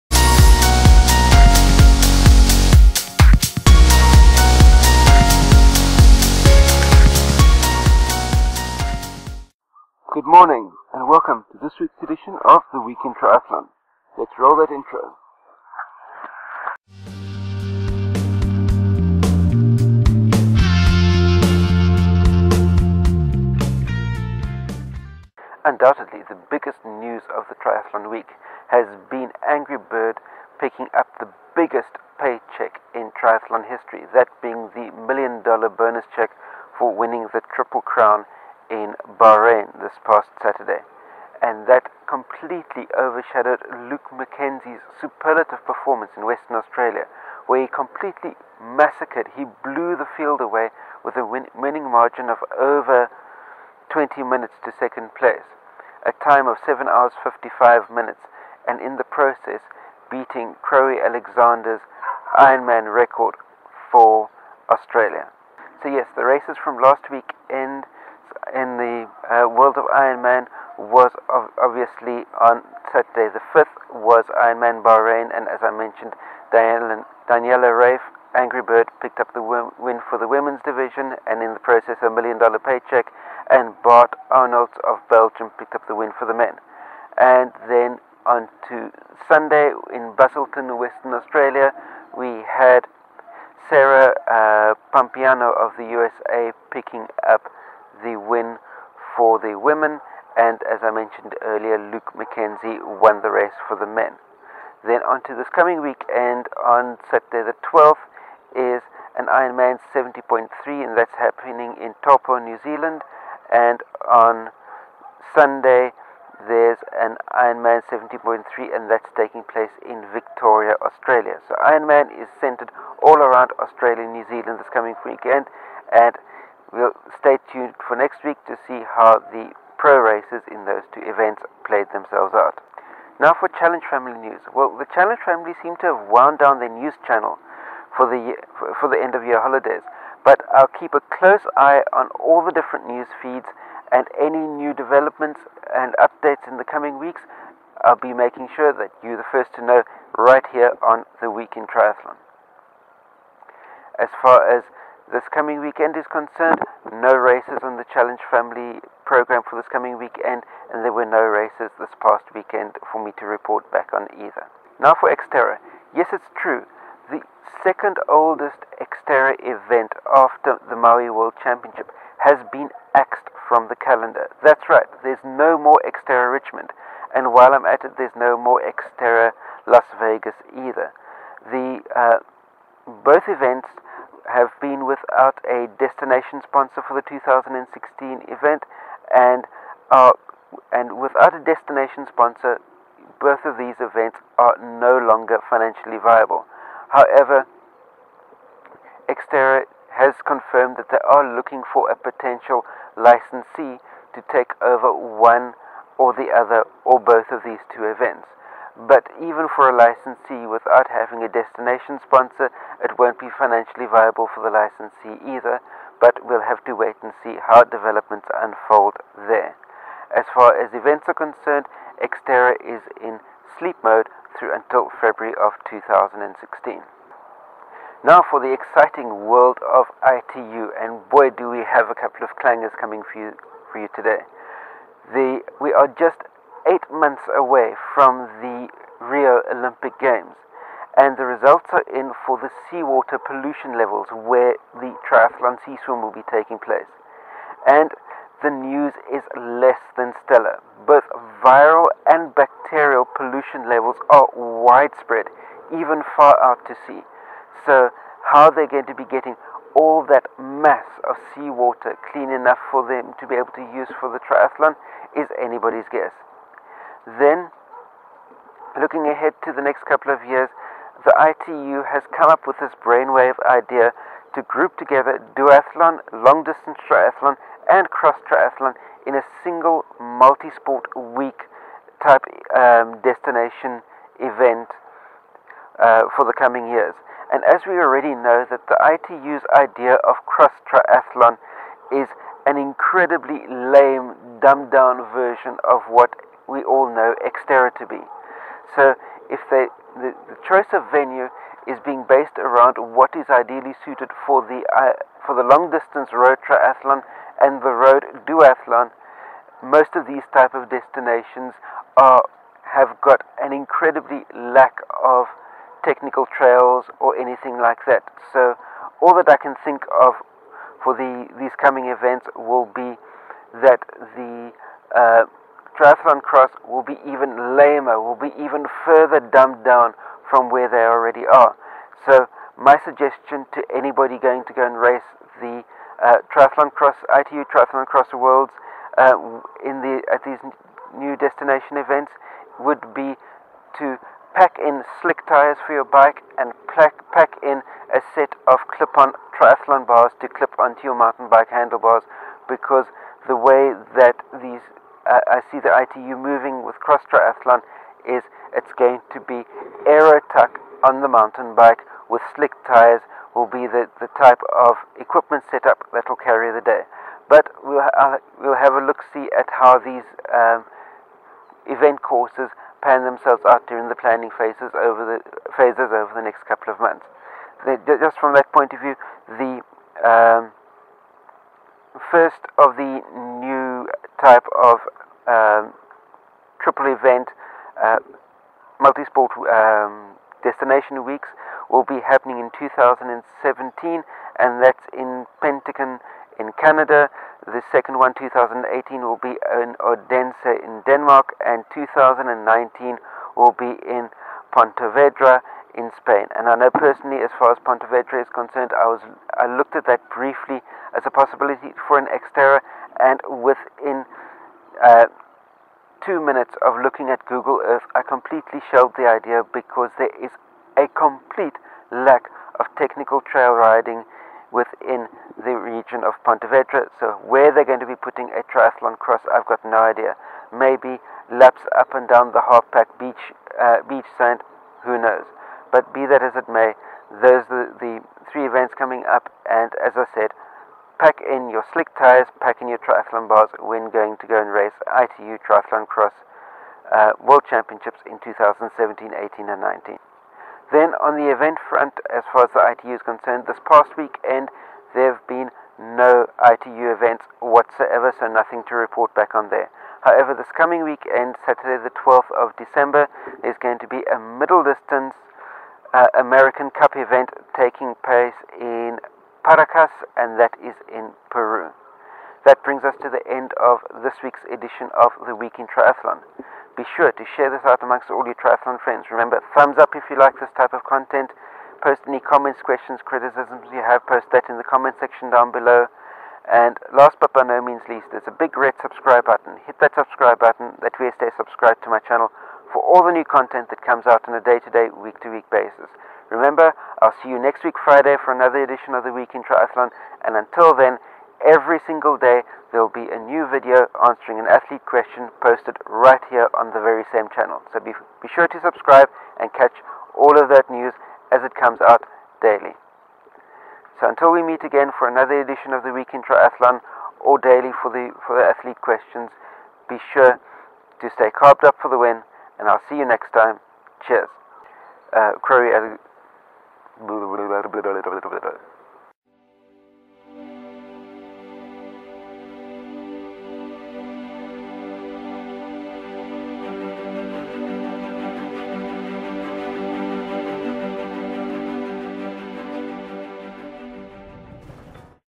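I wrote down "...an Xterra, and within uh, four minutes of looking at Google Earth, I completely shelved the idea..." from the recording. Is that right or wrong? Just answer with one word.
wrong.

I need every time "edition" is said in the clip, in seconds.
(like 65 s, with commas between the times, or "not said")
12 s, 474 s, 498 s, 515 s.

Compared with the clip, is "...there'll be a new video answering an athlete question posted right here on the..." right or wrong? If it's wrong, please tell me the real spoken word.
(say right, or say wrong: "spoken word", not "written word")
right.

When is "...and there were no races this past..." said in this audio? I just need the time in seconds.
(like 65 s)
160 s.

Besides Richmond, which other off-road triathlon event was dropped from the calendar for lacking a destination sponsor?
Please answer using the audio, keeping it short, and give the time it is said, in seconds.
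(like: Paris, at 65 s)
Xterra Las Vegas, at 178 s.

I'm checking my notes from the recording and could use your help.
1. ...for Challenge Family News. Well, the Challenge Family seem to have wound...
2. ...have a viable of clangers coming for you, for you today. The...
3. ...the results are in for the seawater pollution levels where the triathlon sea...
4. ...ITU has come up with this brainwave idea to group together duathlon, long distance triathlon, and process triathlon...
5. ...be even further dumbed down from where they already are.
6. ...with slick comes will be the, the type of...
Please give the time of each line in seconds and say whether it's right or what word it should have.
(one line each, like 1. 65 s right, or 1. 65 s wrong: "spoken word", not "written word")
1. 133 s right
2. 231 s wrong: "couple", not "viable"
3. 241 s right
4. 271 s wrong: "cross", not "process"
5. 328 s right
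6. 362 s wrong: "tires", not "comes".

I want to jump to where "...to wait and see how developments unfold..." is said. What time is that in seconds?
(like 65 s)
216 s.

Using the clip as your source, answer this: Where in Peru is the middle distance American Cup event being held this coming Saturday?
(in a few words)
Paracas.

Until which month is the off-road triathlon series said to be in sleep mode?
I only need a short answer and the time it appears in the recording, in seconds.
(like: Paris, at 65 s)
February, at 225 s.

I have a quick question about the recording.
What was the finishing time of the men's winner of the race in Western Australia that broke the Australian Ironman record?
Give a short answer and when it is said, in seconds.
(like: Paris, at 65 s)
7 hours 55 minutes, at 56 s.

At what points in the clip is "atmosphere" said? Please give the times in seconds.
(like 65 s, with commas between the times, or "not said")
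not said.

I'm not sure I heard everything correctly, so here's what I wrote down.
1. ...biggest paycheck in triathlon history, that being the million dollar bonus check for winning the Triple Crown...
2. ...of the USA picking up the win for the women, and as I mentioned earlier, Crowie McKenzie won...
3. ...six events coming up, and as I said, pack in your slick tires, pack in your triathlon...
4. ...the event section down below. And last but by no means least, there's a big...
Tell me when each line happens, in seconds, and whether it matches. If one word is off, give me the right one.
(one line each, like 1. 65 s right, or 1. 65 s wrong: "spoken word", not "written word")
1. 31 s right
2. 95 s wrong: "Luke", not "Crowie"
3. 438 s wrong: "three", not "six"
4. 484 s wrong: "comment", not "event".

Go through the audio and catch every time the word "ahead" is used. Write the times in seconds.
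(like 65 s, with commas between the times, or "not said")
269 s.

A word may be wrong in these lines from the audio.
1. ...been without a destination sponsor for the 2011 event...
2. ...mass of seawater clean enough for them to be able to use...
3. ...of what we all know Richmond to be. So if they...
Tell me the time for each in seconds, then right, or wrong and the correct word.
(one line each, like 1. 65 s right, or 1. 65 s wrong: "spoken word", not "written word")
1. 184 s wrong: "2016", not "2011"
2. 260 s right
3. 295 s wrong: "Xterra", not "Richmond".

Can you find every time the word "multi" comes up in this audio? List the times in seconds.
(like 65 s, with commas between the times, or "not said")
279 s, 388 s.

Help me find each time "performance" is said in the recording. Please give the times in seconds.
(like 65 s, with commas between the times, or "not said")
45 s.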